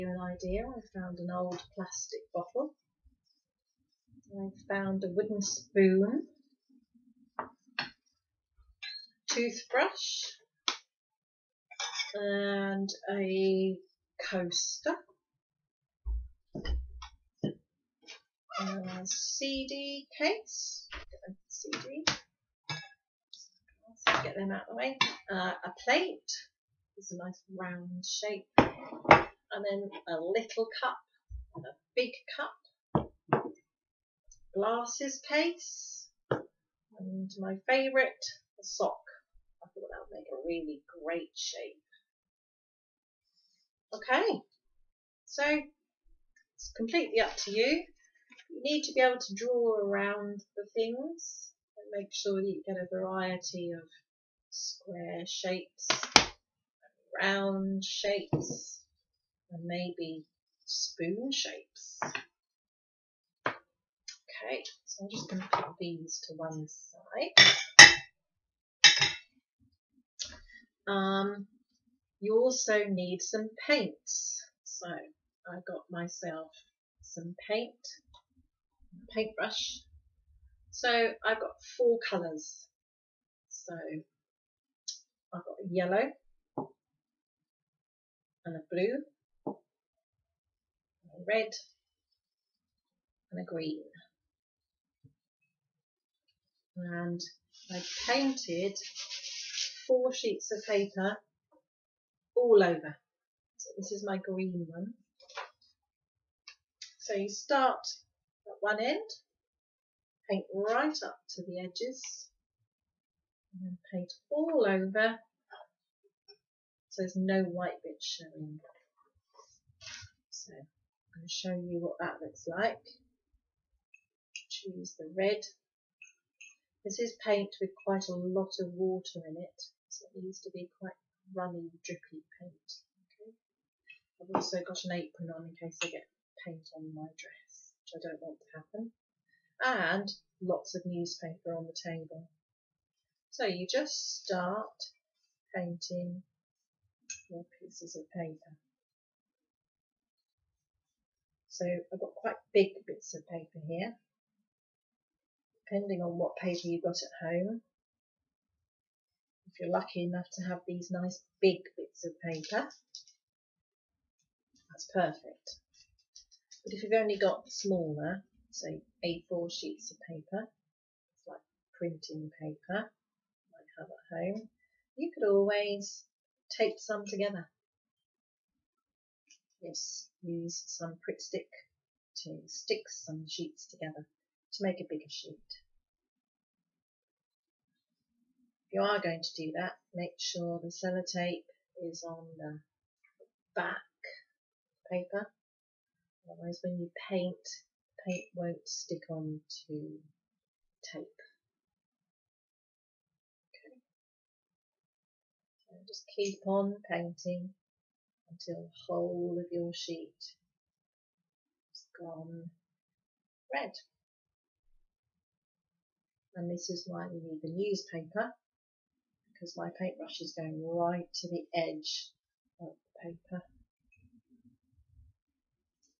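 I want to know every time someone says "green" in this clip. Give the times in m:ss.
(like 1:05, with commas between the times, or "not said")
1:33, 1:44.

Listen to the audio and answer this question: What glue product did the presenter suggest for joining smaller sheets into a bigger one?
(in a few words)
Pritt stick.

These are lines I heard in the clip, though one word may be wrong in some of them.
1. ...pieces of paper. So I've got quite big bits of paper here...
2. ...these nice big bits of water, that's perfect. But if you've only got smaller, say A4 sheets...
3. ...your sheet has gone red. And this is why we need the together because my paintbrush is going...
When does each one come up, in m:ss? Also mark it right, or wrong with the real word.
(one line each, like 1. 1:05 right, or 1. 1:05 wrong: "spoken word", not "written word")
1. 2:27 right
2. 2:40 wrong: "paper", not "water"
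3. 3:29 wrong: "newspaper", not "together".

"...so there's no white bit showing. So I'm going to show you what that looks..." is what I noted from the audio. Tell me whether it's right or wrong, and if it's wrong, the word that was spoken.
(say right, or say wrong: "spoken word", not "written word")
right.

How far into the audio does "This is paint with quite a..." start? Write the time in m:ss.
2:06.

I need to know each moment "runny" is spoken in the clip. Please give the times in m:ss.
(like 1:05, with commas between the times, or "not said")
2:11.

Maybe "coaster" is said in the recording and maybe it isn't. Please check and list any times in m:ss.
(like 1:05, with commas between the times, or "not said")
0:14.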